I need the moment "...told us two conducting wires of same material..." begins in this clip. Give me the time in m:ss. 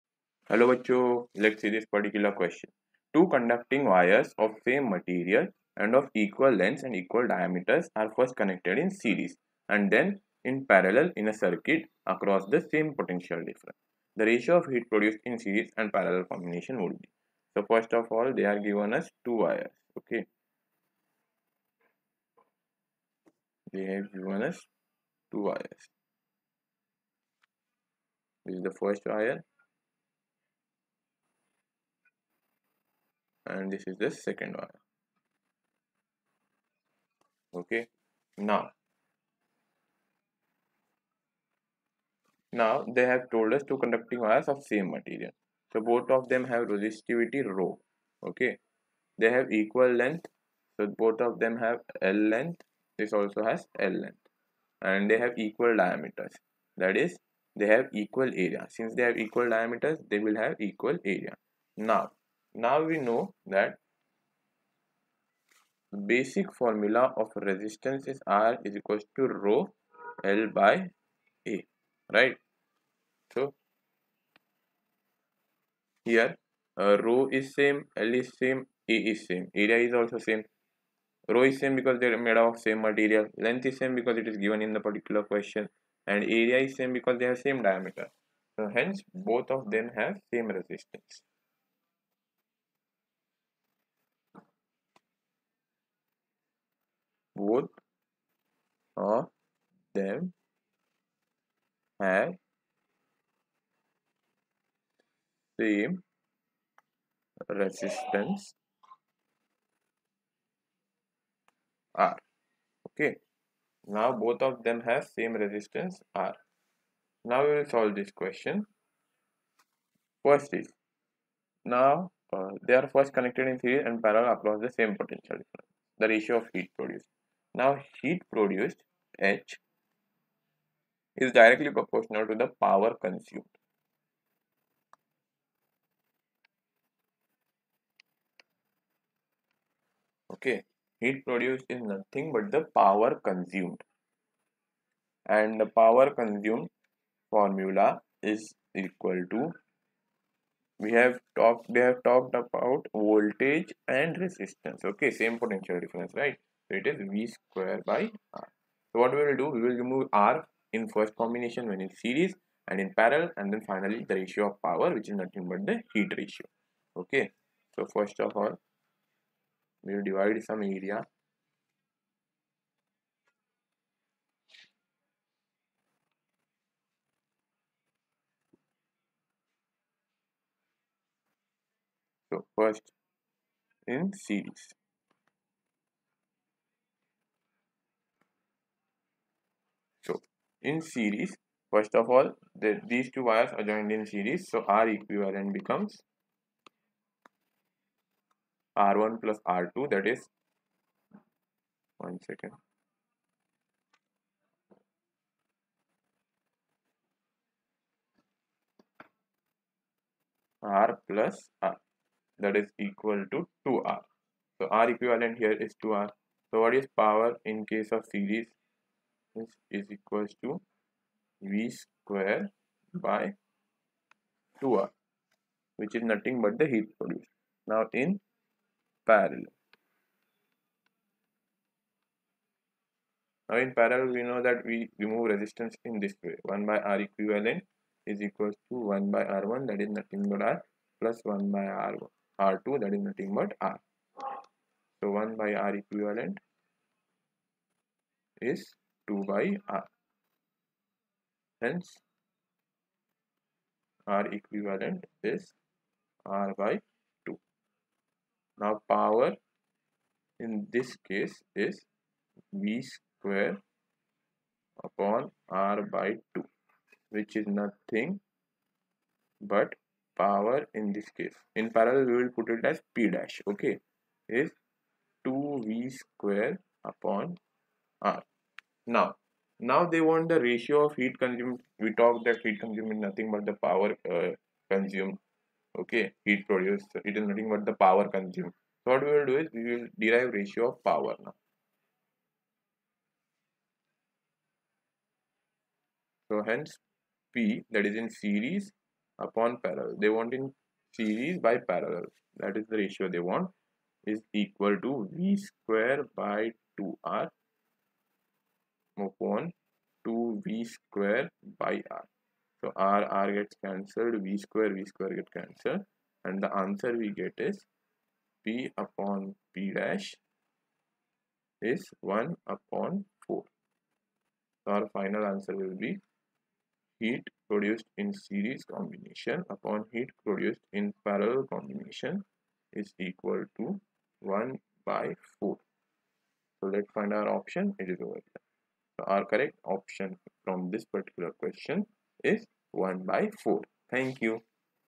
0:43.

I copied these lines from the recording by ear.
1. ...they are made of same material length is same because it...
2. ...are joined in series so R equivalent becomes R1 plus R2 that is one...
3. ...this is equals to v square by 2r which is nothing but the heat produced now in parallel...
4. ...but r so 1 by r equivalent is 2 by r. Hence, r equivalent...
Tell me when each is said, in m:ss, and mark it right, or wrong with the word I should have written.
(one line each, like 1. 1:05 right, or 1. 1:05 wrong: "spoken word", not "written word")
1. 1:21 right
2. 3:13 right
3. 3:39 right
4. 4:03 right.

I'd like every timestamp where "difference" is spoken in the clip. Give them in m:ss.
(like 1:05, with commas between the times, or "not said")
0:13, 2:05, 2:35.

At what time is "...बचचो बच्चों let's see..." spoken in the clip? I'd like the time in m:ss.
0:00.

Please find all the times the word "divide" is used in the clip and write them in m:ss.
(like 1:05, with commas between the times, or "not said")
2:50.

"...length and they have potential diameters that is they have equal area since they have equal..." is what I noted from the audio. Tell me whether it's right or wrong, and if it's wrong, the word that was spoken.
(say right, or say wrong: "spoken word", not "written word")
wrong: "equal", not "potential".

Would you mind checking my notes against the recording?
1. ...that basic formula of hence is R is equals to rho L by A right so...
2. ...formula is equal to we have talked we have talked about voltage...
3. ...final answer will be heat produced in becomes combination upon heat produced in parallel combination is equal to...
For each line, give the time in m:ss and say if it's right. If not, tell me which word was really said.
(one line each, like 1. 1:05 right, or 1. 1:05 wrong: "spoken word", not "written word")
1. 1:03 wrong: "resistance", not "hence"
2. 2:27 right
3. 5:24 wrong: "series", not "becomes".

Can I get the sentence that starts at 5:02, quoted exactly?
That is the ratio they want is equal to V square by 2R upon 2v square by r.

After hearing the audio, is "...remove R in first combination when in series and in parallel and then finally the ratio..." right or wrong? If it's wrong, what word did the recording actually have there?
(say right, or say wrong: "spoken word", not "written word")
right.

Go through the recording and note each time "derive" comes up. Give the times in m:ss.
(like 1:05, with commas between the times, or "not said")
4:49.